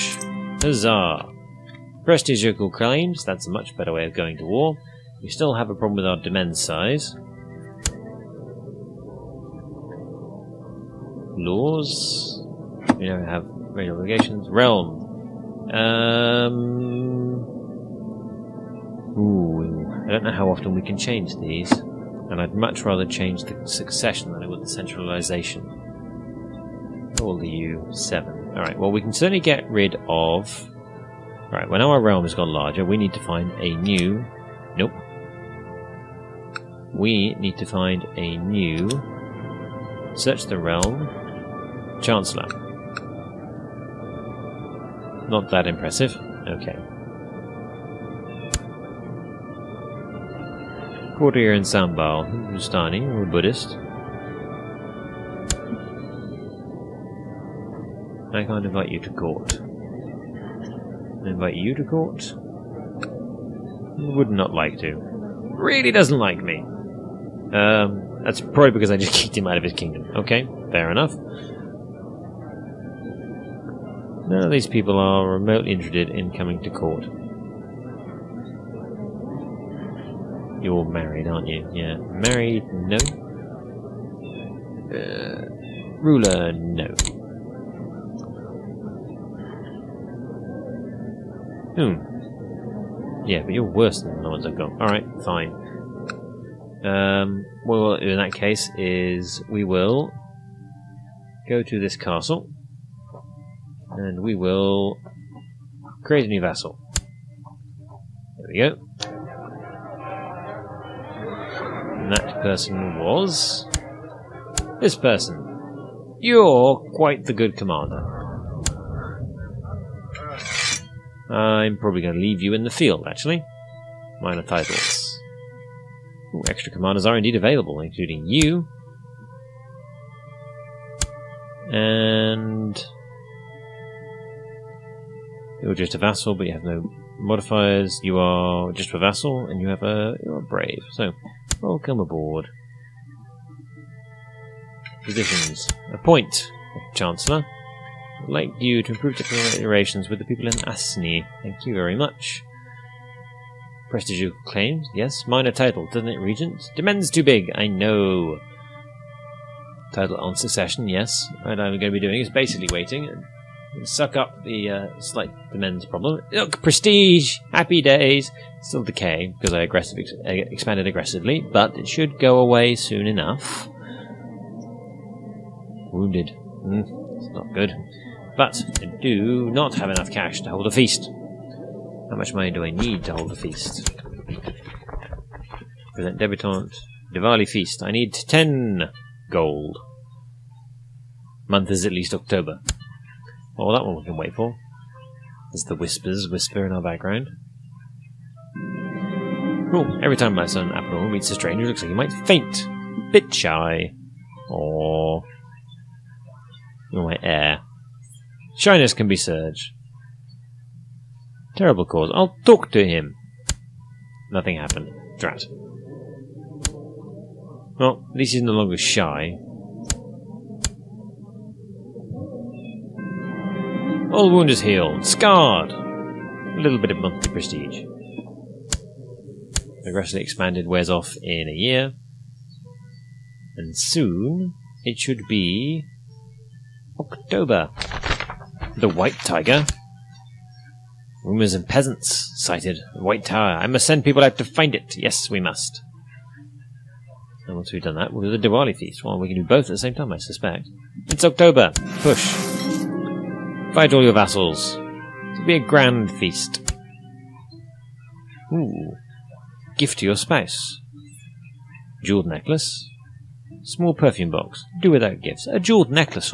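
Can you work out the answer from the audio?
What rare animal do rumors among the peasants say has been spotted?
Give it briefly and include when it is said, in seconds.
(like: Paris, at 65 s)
White Tiger, at 238 s.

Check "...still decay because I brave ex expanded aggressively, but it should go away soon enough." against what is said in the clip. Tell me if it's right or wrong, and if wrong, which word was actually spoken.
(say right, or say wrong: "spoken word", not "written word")
wrong: "aggressive", not "brave".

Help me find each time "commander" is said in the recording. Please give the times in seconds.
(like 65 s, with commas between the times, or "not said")
117 s, 126 s.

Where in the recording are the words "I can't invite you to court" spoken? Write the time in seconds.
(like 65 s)
58 s.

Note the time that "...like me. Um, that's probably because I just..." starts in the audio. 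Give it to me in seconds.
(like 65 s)
66 s.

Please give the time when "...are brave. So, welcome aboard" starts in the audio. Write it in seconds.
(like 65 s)
140 s.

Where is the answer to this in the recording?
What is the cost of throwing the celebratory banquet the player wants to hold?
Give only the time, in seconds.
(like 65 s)
188 s.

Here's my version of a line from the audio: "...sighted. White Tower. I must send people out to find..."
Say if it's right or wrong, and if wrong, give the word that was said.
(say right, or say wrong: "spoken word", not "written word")
right.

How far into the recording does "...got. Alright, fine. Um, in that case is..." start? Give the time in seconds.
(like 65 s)
94 s.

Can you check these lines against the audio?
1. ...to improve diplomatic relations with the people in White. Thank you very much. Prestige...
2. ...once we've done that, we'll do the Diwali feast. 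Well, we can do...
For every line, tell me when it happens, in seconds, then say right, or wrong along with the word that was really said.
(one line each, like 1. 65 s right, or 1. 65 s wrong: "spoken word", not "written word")
1. 148 s wrong: "Asni", not "White"
2. 247 s right.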